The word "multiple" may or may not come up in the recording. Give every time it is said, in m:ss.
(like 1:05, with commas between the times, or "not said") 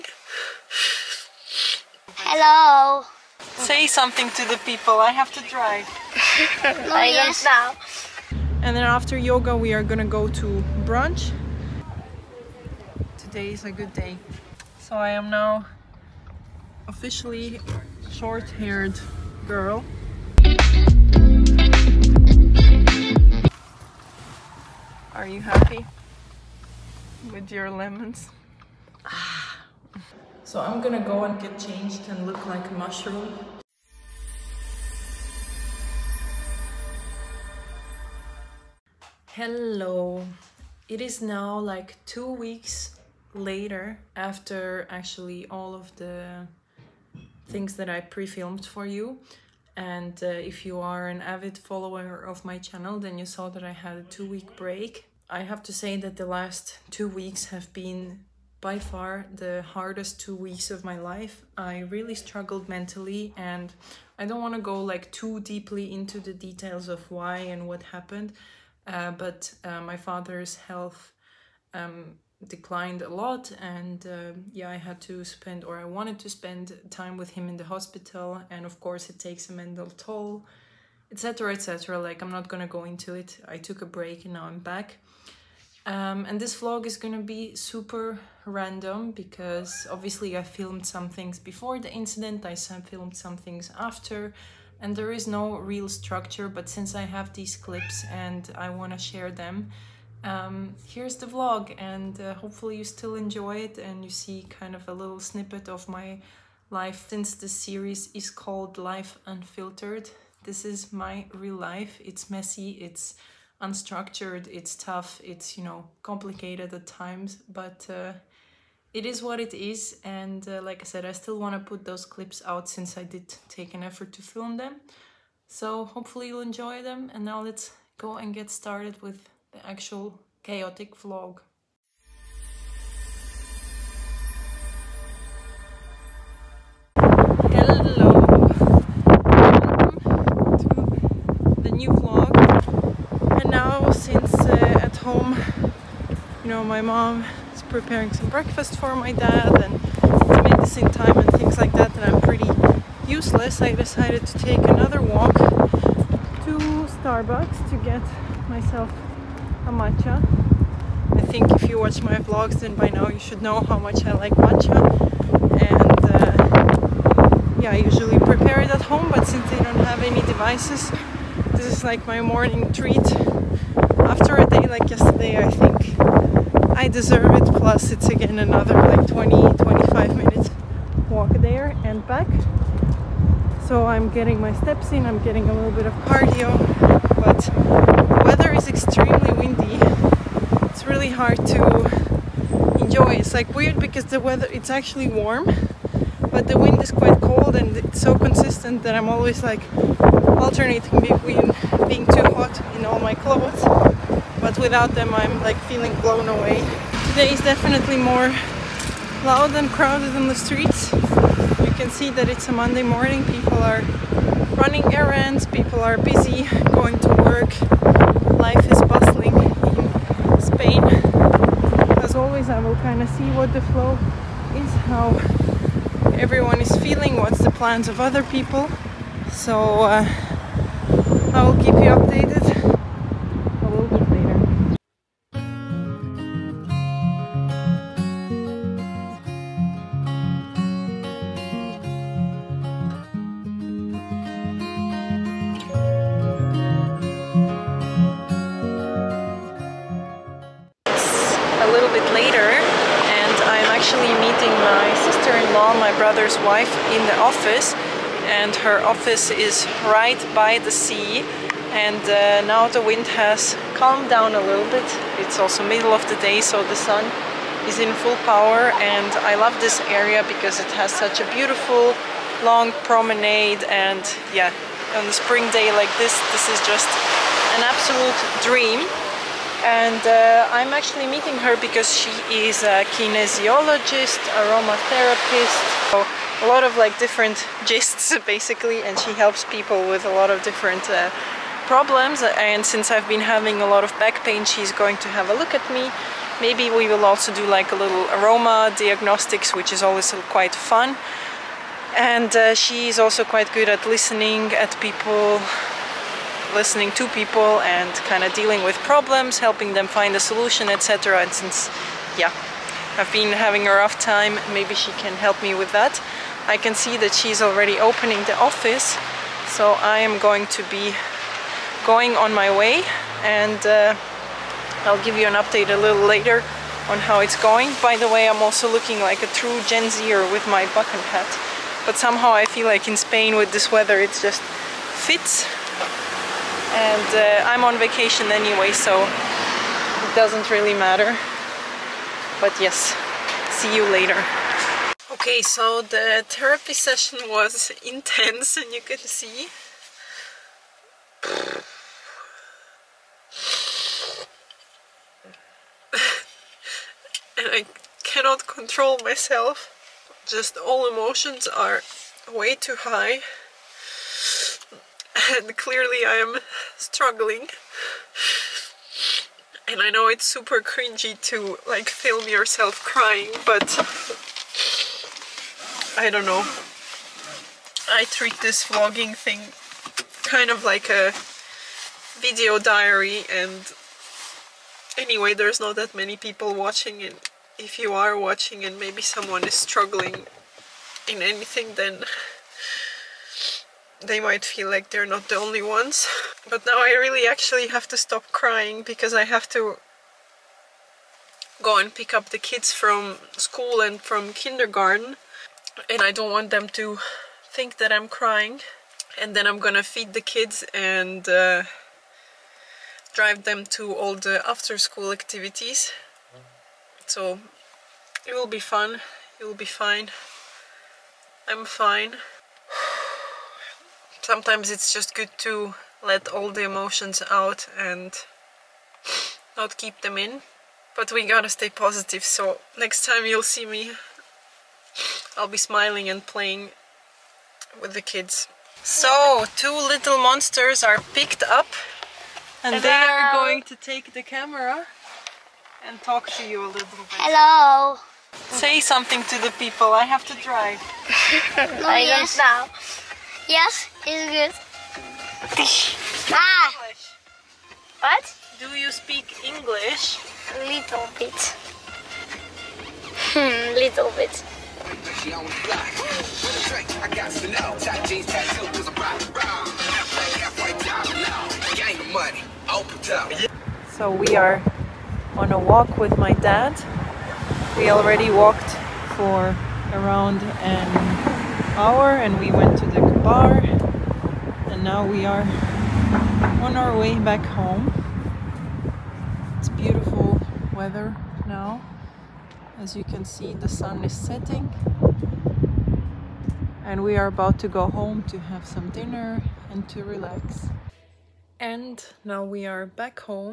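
not said.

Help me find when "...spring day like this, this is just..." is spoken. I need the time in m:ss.
4:35.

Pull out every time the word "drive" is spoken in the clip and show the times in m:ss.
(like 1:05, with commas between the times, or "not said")
0:05, 6:53, 7:30.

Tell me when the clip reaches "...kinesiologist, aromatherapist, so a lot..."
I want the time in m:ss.
4:42.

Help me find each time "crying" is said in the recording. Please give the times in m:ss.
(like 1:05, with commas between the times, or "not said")
6:12, 6:38, 6:48.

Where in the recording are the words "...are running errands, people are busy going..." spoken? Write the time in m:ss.
3:33.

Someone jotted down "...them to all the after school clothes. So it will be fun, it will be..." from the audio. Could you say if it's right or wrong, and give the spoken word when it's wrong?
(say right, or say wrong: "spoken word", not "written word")
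wrong: "activities", not "clothes".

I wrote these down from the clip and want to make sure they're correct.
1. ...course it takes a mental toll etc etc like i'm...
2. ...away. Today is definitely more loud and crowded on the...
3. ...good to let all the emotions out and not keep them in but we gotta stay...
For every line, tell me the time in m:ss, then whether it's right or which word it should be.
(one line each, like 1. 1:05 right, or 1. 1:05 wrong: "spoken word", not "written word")
1. 1:18 right
2. 3:26 right
3. 7:05 right.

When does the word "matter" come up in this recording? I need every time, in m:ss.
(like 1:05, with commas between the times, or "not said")
5:40.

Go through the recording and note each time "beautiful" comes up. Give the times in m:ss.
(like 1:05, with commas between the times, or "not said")
4:31, 8:09.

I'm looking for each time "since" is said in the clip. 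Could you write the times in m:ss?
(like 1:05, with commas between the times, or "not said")
1:36, 1:47, 2:02, 2:23, 2:49, 4:52, 5:11.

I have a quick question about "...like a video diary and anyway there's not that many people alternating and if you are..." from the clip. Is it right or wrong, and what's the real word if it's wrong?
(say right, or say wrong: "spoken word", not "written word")
wrong: "watching", not "alternating".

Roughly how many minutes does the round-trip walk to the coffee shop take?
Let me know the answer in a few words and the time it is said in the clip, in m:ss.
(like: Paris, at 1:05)
20-25 minutes, at 2:59.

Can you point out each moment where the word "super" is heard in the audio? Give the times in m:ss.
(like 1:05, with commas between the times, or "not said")
1:27, 6:10.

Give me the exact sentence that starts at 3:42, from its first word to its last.
As always, I will kind of see what the flow is, how everyone is feeling, what's the plans of other people.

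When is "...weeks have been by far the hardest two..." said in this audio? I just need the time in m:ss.
0:57.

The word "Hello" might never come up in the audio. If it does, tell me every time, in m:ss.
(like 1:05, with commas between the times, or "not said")
0:02, 0:39, 2:16, 7:22, 7:27.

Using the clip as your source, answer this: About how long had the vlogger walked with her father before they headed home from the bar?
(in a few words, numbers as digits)
around an hour.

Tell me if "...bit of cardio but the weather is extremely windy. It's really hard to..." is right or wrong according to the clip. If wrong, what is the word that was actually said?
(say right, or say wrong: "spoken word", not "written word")
right.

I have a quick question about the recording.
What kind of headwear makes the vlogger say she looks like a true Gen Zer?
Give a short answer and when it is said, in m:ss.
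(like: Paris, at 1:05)
bucket hat, at 5:30.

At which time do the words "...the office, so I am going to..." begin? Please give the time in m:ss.
5:18.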